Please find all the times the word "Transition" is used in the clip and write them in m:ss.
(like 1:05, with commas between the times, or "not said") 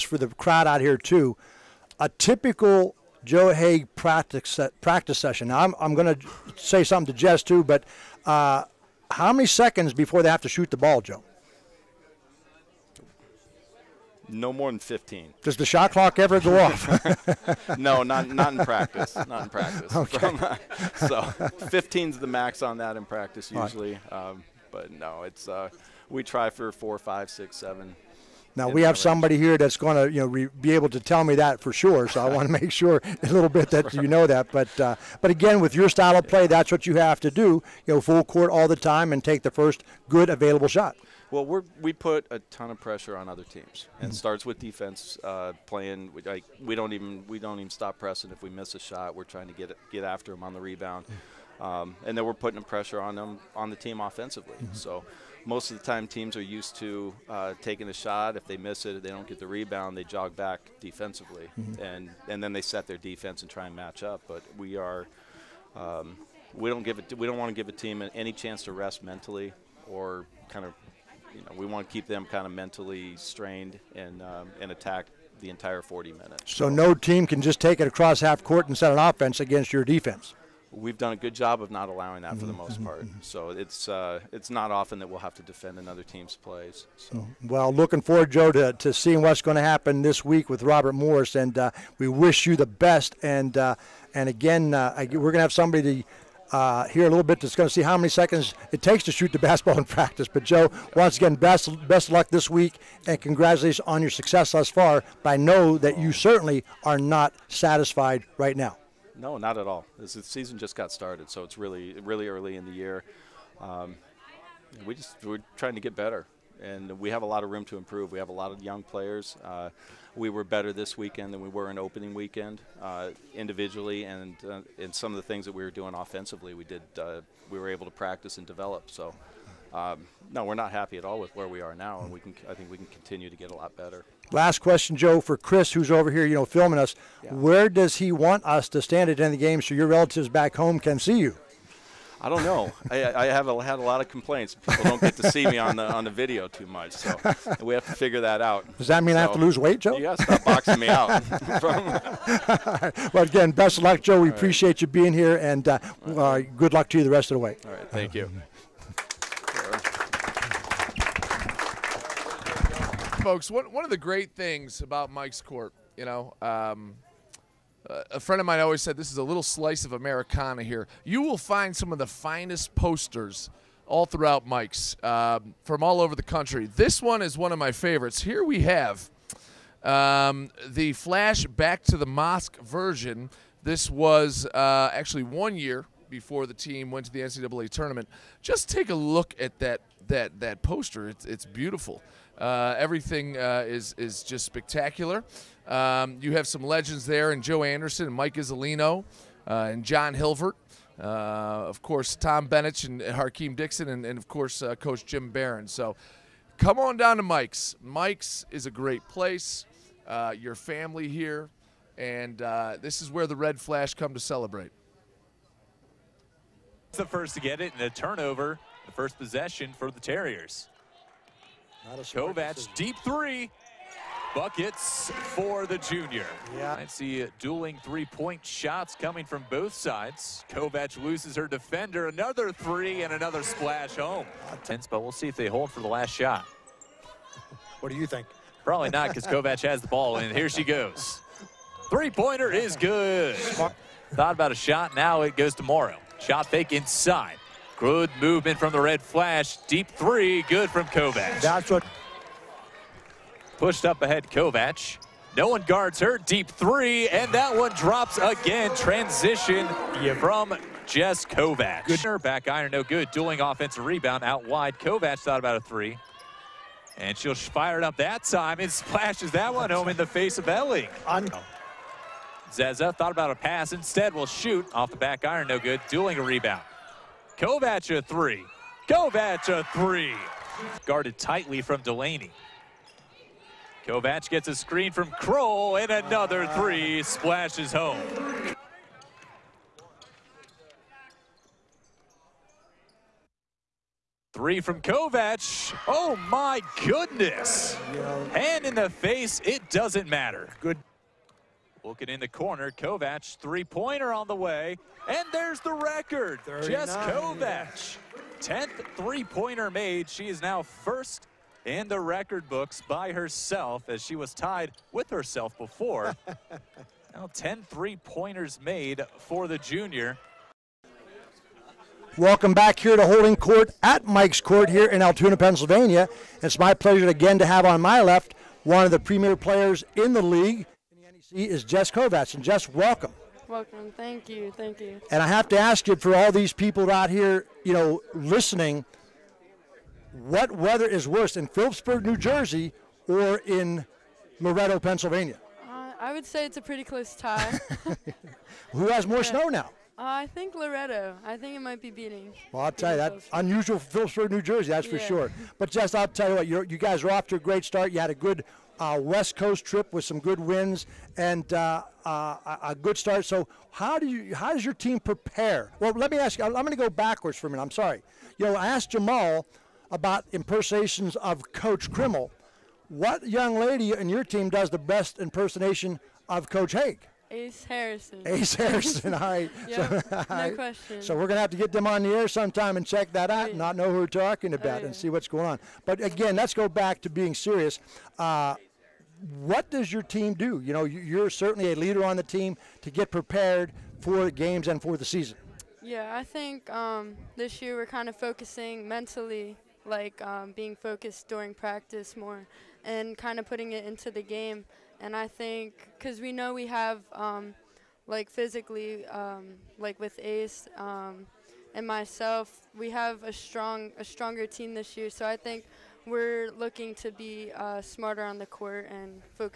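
4:18.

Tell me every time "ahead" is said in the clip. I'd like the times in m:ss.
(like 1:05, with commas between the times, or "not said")
4:14.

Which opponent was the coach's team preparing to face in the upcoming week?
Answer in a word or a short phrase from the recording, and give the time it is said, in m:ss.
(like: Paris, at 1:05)
Robert Morris, at 1:30.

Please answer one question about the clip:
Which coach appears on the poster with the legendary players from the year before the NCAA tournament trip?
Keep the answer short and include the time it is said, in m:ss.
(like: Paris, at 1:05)
Jim Baron, at 3:24.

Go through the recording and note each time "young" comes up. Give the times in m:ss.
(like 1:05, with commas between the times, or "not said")
1:58, 6:13.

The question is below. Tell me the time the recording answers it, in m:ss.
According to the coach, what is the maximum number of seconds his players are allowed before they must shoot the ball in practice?
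0:14.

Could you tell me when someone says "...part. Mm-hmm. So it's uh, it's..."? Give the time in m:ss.
1:22.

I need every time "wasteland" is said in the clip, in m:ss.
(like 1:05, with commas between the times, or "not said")
not said.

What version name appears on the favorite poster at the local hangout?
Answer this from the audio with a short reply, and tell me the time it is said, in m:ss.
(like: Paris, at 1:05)
Flash Back to the Mosque, at 3:00.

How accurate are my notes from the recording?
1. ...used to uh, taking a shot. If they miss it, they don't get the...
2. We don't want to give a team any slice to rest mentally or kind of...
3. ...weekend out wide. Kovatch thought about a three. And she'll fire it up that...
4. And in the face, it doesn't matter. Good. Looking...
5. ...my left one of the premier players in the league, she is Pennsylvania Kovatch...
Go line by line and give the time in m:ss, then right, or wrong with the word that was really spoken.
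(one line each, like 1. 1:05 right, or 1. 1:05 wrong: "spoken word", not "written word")
1. 0:56 right
2. 1:07 wrong: "chance", not "slice"
3. 4:23 wrong: "rebound", not "weekend"
4. 4:58 right
5. 5:27 wrong: "Jess", not "Pennsylvania".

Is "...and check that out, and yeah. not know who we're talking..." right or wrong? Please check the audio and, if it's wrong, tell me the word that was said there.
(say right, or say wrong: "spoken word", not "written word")
right.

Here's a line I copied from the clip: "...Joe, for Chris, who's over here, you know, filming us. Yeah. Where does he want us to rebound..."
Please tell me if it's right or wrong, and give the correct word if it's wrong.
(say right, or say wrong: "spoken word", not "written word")
wrong: "stand", not "rebound".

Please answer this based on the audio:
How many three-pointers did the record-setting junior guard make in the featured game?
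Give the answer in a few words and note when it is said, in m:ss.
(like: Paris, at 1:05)
10, at 5:08.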